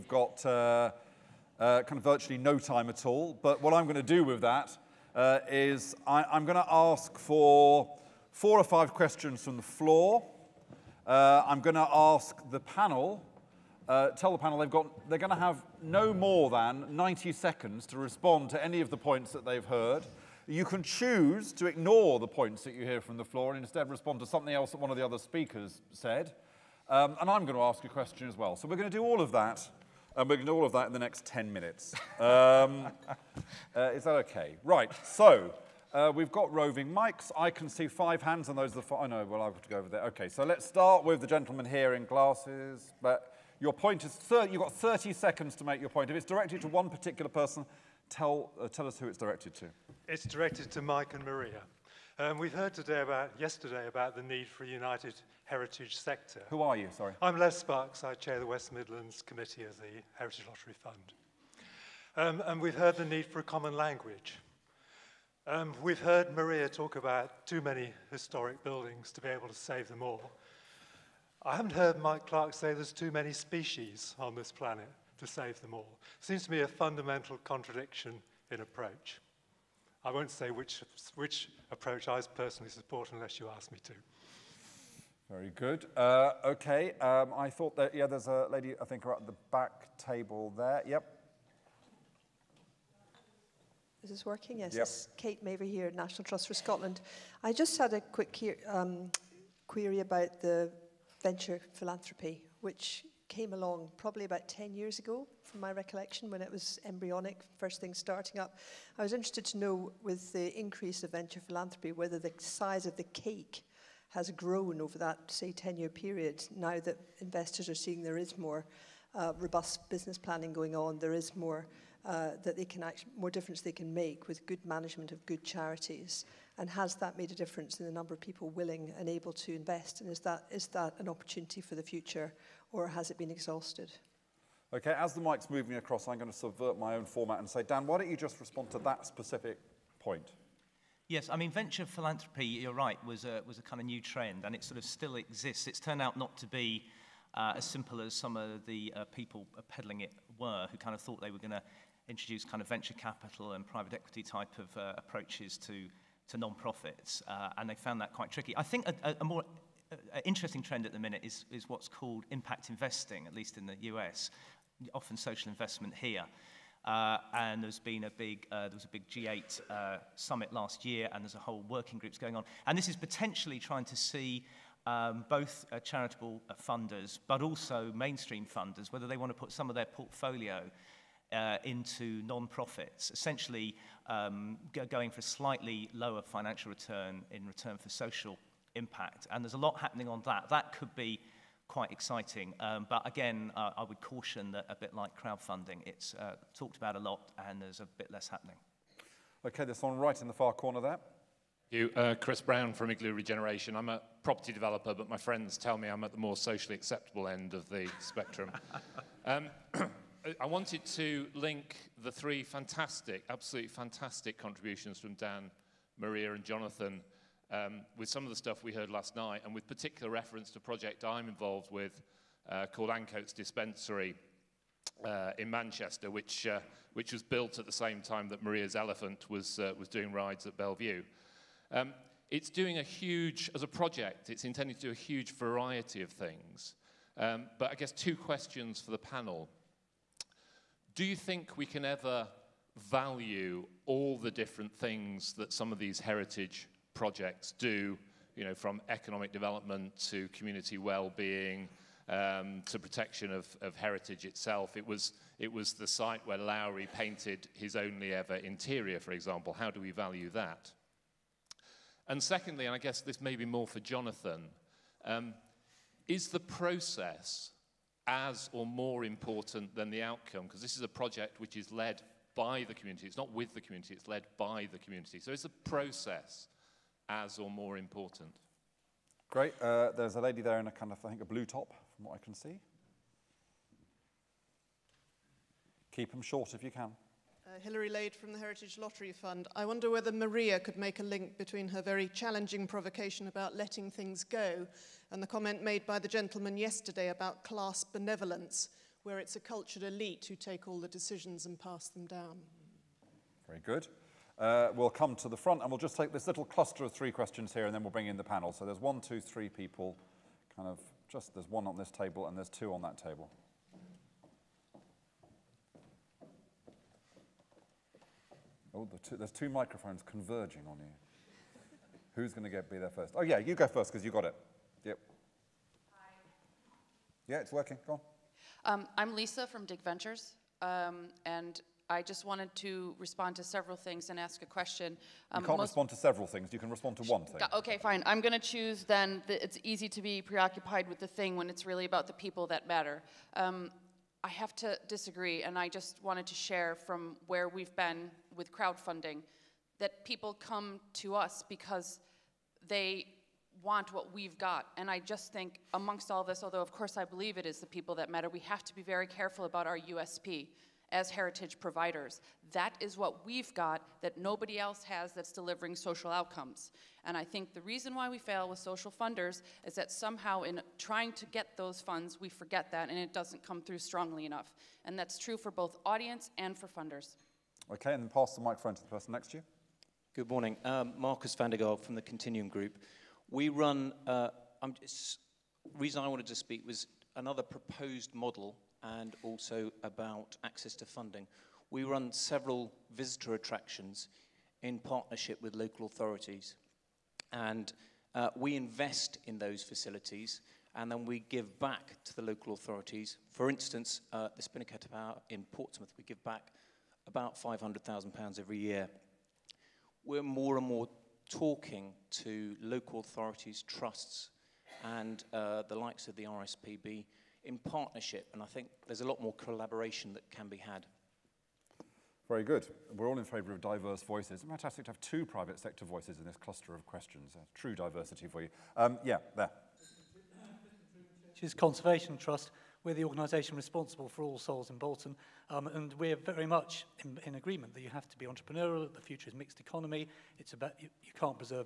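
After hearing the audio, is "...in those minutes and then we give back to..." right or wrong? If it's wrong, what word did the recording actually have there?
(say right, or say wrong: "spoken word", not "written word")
wrong: "facilities", not "minutes".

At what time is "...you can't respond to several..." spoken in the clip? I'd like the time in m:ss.
5:35.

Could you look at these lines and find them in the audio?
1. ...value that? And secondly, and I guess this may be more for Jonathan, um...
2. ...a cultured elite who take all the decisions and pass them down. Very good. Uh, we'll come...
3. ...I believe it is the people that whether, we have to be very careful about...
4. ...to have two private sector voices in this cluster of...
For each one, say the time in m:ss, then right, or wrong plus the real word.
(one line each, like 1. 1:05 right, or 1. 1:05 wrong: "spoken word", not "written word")
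1. 4:19 right
2. 4:59 right
3. 5:56 wrong: "matter", not "whether"
4. 7:04 right.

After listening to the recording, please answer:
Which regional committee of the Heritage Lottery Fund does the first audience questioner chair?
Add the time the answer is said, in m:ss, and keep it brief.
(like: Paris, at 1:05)
West Midlands, at 0:58.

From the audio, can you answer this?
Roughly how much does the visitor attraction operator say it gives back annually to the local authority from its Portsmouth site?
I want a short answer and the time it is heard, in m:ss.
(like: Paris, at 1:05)
£500,000, at 6:47.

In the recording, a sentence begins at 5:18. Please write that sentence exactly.
Oh, the two, there's two microphones converging on you.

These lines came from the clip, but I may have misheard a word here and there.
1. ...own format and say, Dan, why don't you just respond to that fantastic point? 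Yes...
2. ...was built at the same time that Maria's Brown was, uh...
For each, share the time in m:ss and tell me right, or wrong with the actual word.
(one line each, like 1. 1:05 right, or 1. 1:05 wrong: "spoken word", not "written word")
1. 2:16 wrong: "specific", not "fantastic"
2. 3:47 wrong: "Elephant", not "Brown".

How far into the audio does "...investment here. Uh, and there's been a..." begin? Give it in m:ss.
2:45.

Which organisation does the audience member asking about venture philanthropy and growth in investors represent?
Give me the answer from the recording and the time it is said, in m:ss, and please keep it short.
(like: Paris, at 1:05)
National Trust for Scotland, at 1:35.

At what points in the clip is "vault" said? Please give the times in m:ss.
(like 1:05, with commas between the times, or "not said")
not said.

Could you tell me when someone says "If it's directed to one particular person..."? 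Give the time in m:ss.
0:46.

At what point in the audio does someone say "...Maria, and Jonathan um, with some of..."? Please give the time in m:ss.
3:35.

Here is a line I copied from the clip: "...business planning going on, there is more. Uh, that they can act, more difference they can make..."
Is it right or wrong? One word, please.
right.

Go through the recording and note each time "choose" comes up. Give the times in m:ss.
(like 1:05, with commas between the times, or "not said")
0:20, 5:38.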